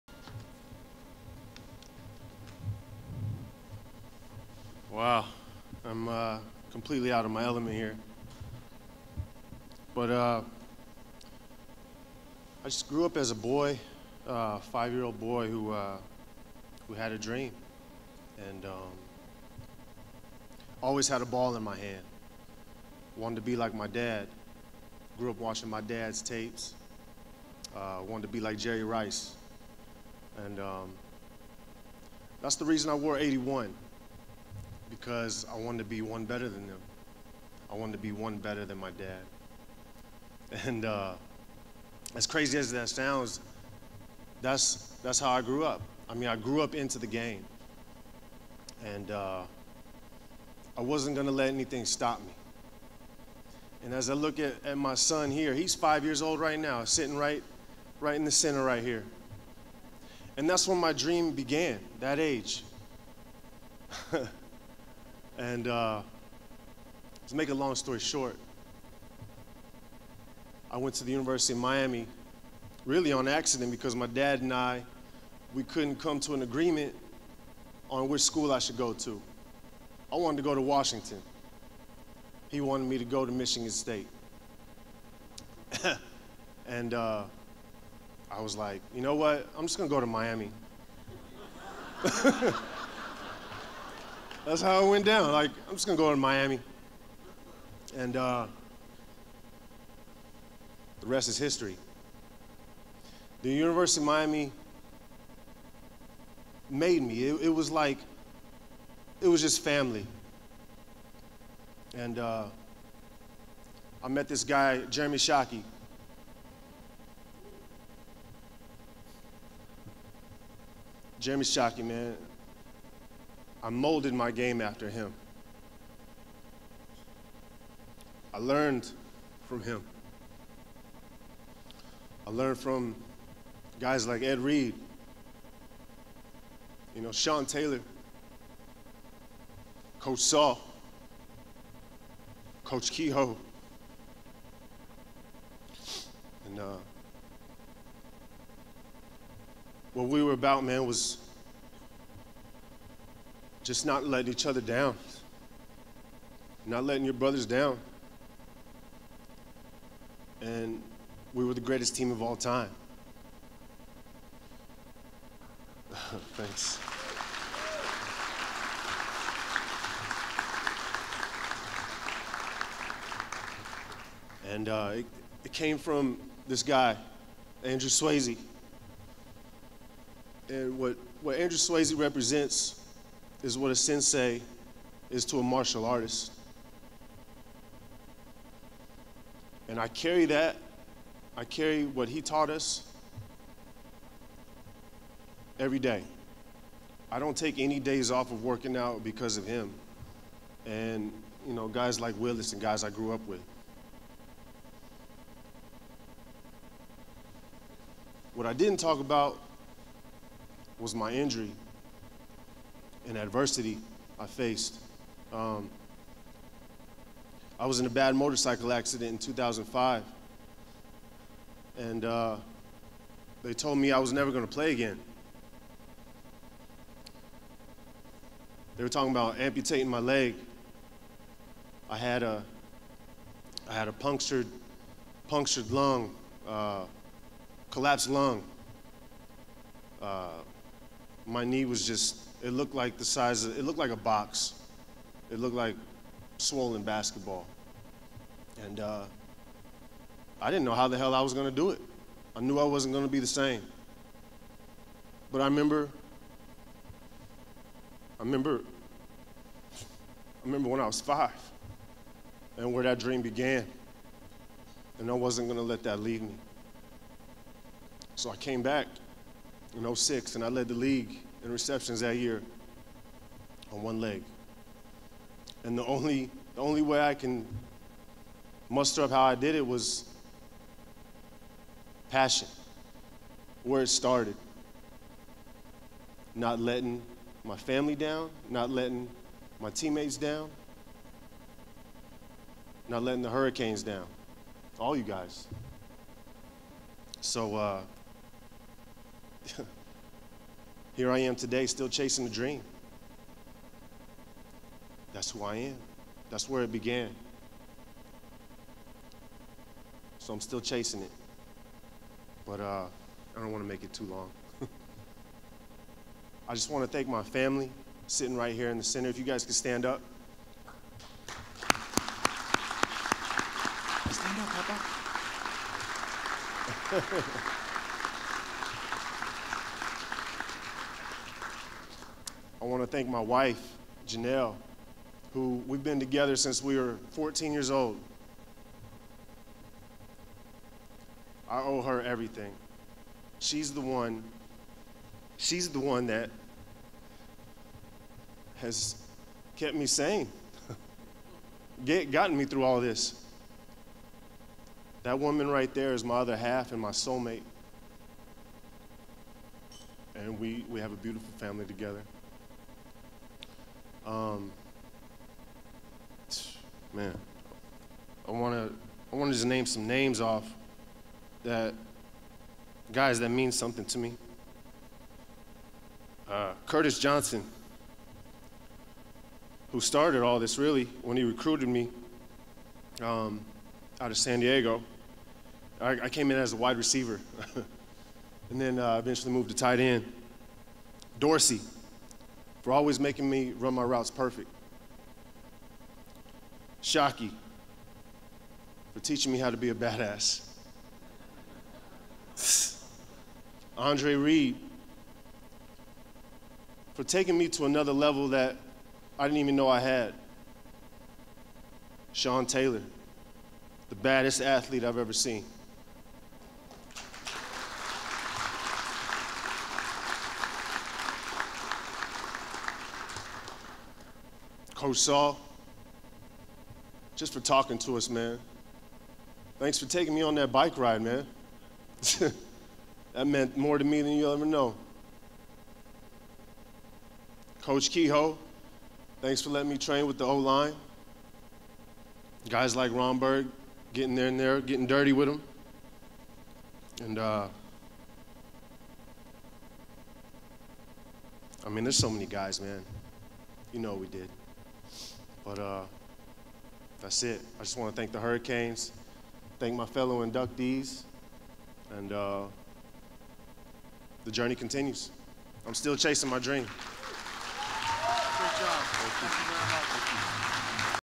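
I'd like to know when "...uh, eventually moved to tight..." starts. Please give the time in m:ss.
6:28.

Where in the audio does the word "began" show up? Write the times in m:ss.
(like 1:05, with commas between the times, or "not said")
1:01, 4:23, 5:06.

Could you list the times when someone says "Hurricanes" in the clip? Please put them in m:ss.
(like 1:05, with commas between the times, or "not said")
4:53, 7:38.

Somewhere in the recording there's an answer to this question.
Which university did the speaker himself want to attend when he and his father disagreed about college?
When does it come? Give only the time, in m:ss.
1:20.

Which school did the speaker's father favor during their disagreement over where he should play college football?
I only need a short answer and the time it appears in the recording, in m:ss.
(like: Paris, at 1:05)
Michigan State, at 1:23.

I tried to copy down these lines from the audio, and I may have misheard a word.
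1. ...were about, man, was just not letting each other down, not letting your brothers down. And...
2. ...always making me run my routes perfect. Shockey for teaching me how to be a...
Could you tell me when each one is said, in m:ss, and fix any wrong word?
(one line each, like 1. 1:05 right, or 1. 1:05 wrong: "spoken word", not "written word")
1. 2:30 right
2. 6:32 right.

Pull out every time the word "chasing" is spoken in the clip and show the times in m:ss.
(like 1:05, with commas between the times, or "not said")
5:01, 5:10, 7:45.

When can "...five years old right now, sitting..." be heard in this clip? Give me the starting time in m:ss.
0:55.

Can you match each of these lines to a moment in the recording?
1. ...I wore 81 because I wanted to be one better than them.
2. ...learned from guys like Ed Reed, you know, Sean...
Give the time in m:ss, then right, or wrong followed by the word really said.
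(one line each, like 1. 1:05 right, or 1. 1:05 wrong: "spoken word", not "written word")
1. 0:32 right
2. 2:12 right.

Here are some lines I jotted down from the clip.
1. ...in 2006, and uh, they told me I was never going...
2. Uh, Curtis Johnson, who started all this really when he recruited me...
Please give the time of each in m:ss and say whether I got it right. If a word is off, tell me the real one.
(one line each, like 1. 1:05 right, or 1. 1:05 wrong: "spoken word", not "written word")
1. 3:39 wrong: "2005", not "2006"
2. 6:16 right.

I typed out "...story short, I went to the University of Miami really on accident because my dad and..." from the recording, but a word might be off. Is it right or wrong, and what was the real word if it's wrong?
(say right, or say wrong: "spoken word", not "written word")
right.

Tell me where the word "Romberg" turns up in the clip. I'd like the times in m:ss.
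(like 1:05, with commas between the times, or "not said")
7:22.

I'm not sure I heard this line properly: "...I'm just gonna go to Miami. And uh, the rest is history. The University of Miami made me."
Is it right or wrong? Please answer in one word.
right.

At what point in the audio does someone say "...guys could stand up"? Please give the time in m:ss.
5:19.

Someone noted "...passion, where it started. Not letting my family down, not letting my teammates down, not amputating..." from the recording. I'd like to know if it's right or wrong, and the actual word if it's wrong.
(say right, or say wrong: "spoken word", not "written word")
wrong: "letting", not "amputating".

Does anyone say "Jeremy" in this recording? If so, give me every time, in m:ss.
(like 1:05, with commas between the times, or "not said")
1:54, 2:01.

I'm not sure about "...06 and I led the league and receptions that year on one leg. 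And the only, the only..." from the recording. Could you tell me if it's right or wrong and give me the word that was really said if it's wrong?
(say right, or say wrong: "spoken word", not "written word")
right.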